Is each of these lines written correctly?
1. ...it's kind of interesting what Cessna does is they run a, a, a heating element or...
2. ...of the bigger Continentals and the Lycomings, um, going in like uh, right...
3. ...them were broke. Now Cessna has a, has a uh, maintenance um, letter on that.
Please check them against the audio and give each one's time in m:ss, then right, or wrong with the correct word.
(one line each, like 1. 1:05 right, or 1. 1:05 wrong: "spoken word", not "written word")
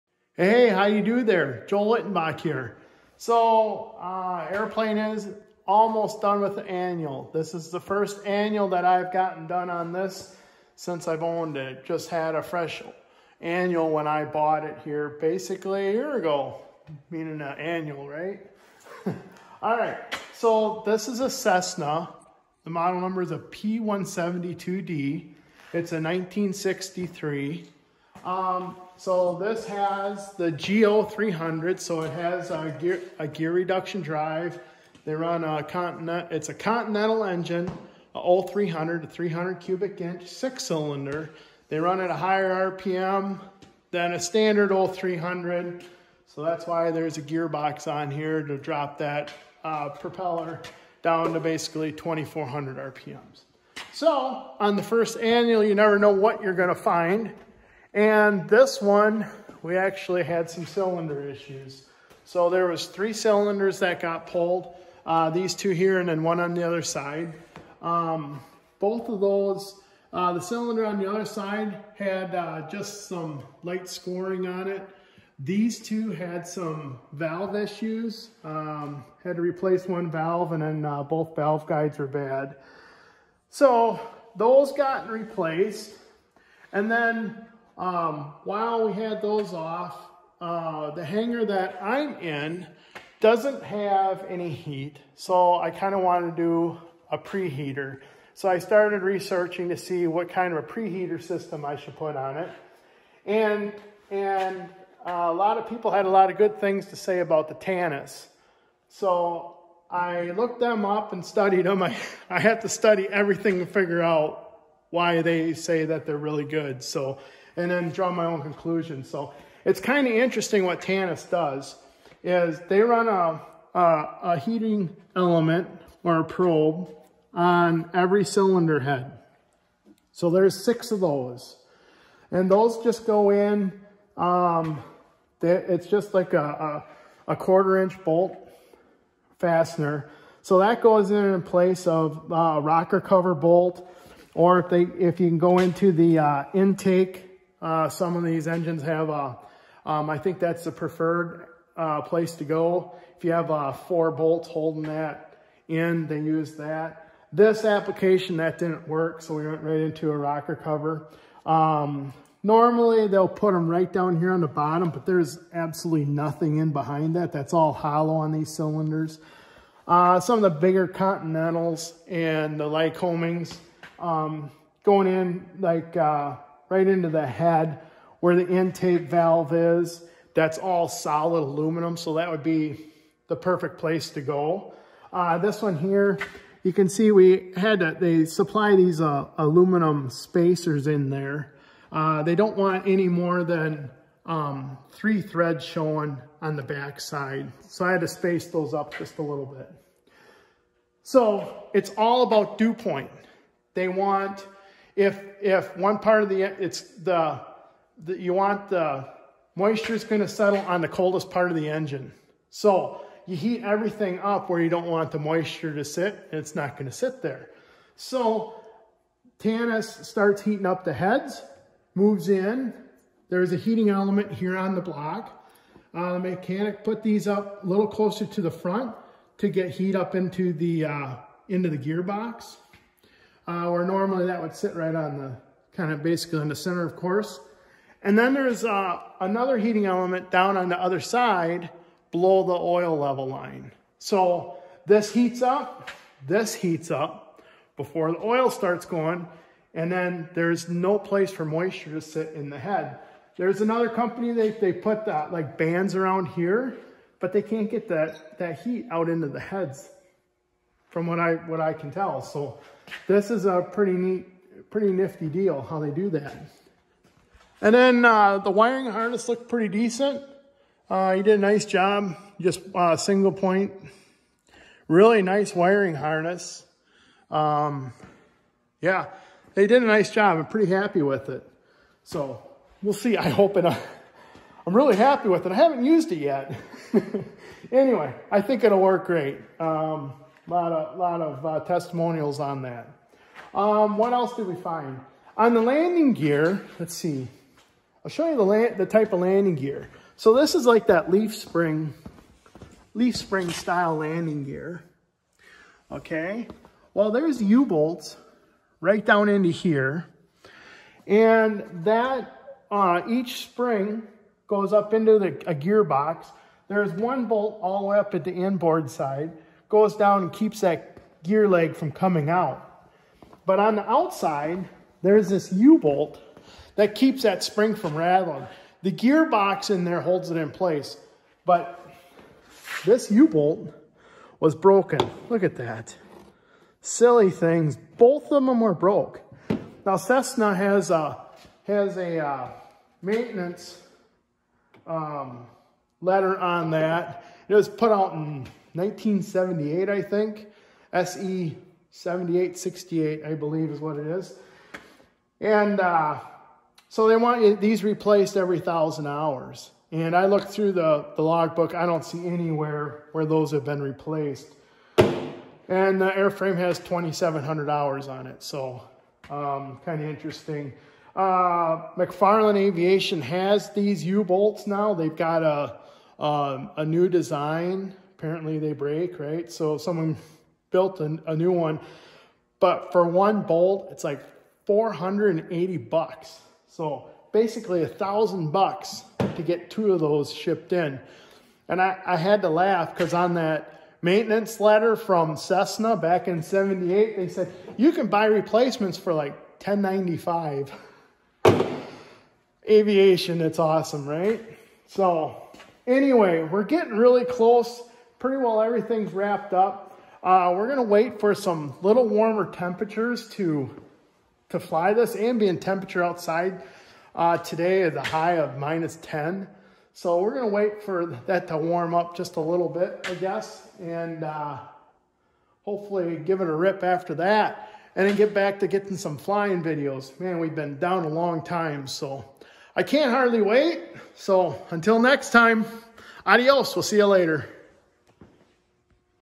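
1. 1:59 wrong: "Tanis", not "Cessna"
2. 2:50 right
3. 5:38 right.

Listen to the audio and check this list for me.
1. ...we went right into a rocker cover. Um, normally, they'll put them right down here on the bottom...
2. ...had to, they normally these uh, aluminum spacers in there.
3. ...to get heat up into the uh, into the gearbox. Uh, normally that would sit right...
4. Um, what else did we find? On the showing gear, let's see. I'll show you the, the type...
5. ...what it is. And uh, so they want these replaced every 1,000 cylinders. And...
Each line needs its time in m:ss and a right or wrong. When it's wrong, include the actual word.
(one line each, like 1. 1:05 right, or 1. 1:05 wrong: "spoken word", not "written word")
1. 2:39 right
2. 3:07 wrong: "supply", not "normally"
3. 3:49 right
4. 4:53 wrong: "landing", not "showing"
5. 5:53 wrong: "hours", not "cylinders".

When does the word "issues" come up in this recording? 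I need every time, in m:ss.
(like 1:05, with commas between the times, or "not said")
1:01, 1:17.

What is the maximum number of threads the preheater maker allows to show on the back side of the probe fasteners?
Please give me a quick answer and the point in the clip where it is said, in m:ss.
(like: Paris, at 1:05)
3, at 3:14.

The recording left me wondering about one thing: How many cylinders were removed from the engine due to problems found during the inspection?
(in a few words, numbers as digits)
3.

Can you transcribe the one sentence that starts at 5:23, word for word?
But on the outside, there's this U-bolt that keeps that spring from rattling.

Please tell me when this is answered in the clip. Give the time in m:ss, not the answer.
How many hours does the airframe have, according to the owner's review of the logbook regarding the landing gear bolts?
6:06.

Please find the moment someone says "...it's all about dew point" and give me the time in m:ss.
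3:21.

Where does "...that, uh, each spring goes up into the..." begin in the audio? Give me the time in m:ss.
5:11.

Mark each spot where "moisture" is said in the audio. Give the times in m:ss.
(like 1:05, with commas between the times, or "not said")
3:29, 3:35, 4:11.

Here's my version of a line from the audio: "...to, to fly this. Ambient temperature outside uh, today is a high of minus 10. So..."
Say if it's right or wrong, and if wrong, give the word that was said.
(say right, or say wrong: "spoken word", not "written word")
right.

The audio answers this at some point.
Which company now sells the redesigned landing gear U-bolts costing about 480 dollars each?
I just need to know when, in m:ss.
6:11.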